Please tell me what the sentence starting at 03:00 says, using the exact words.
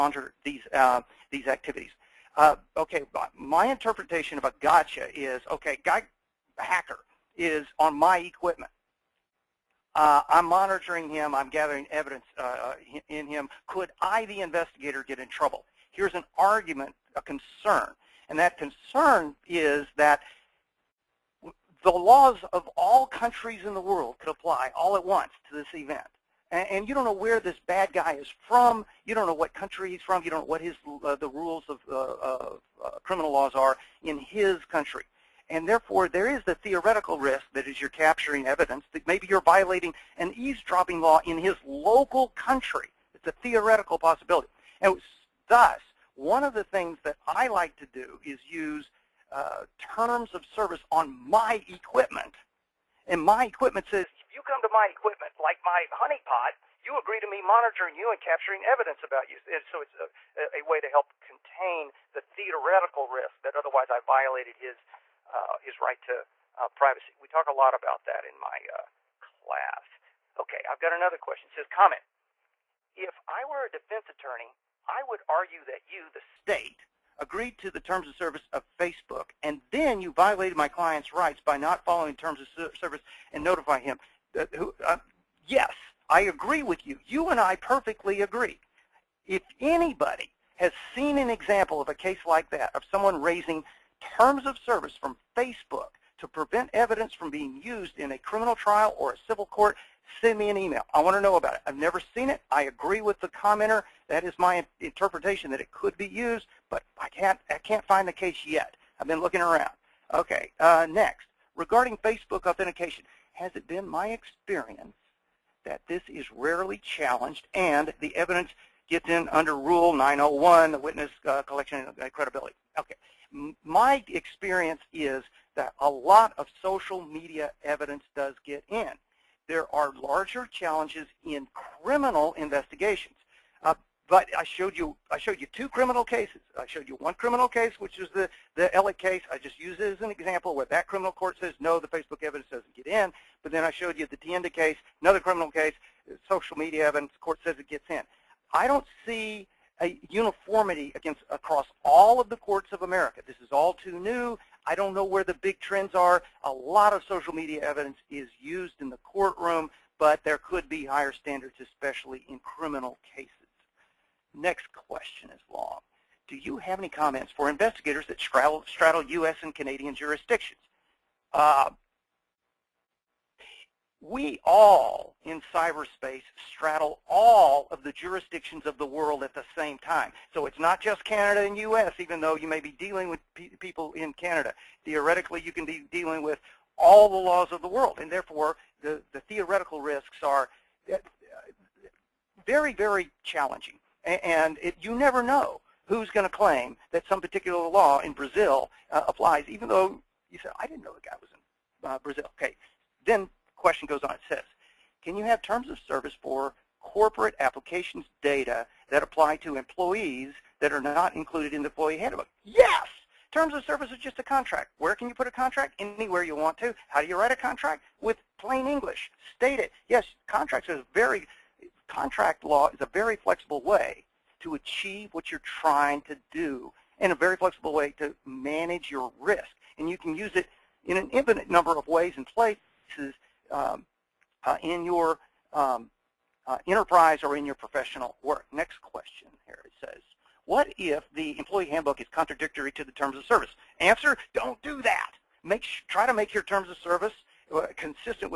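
So it's not just Canada and U.S., even though you may be dealing with pe people in Canada.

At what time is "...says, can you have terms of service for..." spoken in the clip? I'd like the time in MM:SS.
03:24.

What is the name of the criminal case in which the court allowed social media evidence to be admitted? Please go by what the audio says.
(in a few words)
Tienda.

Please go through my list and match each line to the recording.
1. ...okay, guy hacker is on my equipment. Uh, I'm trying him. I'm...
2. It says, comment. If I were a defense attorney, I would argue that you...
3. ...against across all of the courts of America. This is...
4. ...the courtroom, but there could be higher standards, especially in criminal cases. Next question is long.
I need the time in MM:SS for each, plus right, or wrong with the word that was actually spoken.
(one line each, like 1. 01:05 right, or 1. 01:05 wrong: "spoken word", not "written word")
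1. 00:05 wrong: "monitoring", not "trying"
2. 01:11 right
3. 02:30 right
4. 02:38 right.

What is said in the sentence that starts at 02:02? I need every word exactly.
Okay, M my experience is that a lot of social media evidence does get in there are larger challenges in criminal investigations.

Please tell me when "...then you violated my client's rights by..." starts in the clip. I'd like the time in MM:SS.
01:19.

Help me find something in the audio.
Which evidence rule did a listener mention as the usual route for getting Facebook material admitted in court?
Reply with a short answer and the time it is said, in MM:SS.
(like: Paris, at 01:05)
Rule 901, at 01:59.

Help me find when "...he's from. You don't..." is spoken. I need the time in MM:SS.
00:29.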